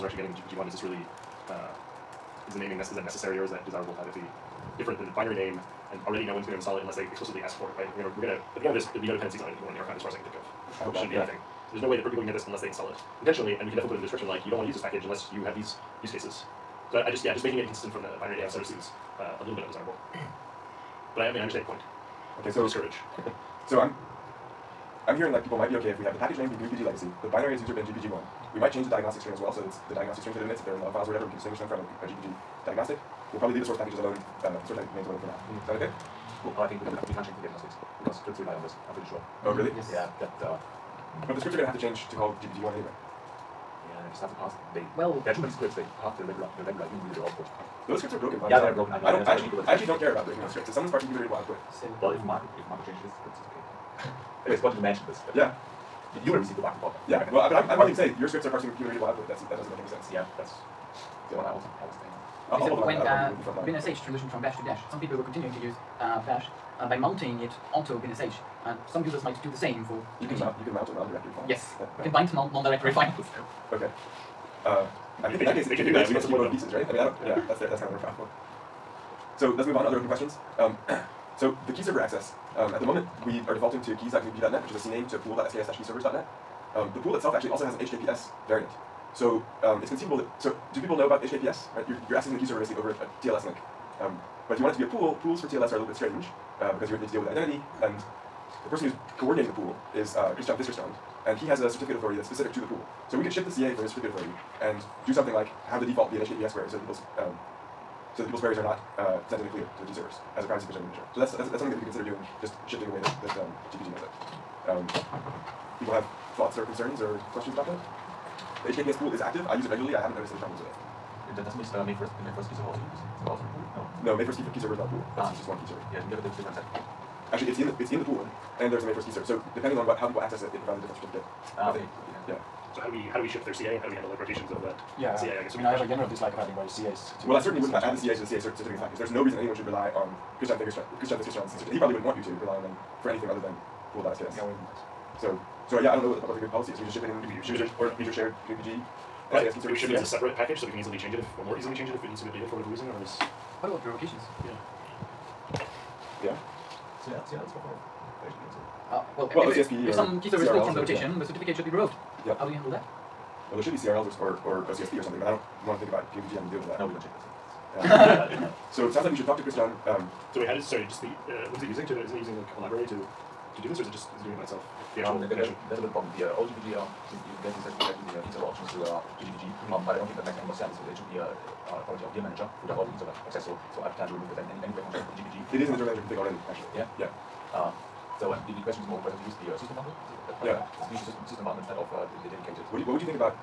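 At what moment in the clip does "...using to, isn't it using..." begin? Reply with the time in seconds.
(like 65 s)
171 s.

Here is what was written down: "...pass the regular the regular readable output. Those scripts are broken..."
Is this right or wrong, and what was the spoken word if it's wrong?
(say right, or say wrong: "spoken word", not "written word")
right.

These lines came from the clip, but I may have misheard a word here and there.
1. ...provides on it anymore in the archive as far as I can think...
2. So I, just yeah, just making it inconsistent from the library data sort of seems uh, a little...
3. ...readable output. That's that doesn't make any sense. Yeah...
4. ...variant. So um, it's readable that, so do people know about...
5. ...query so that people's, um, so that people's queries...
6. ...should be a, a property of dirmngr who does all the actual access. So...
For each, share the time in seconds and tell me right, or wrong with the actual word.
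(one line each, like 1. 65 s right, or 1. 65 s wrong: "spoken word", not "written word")
1. 9 s wrong: "dependencies", not "provides"
2. 16 s wrong: "binary", not "library"
3. 58 s right
4. 88 s wrong: "conceivable", not "readable"
5. 106 s right
6. 180 s wrong: "interval", not "actual".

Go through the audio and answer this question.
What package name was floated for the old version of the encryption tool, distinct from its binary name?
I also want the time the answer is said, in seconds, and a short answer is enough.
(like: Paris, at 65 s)
gpg legacy, at 26 s.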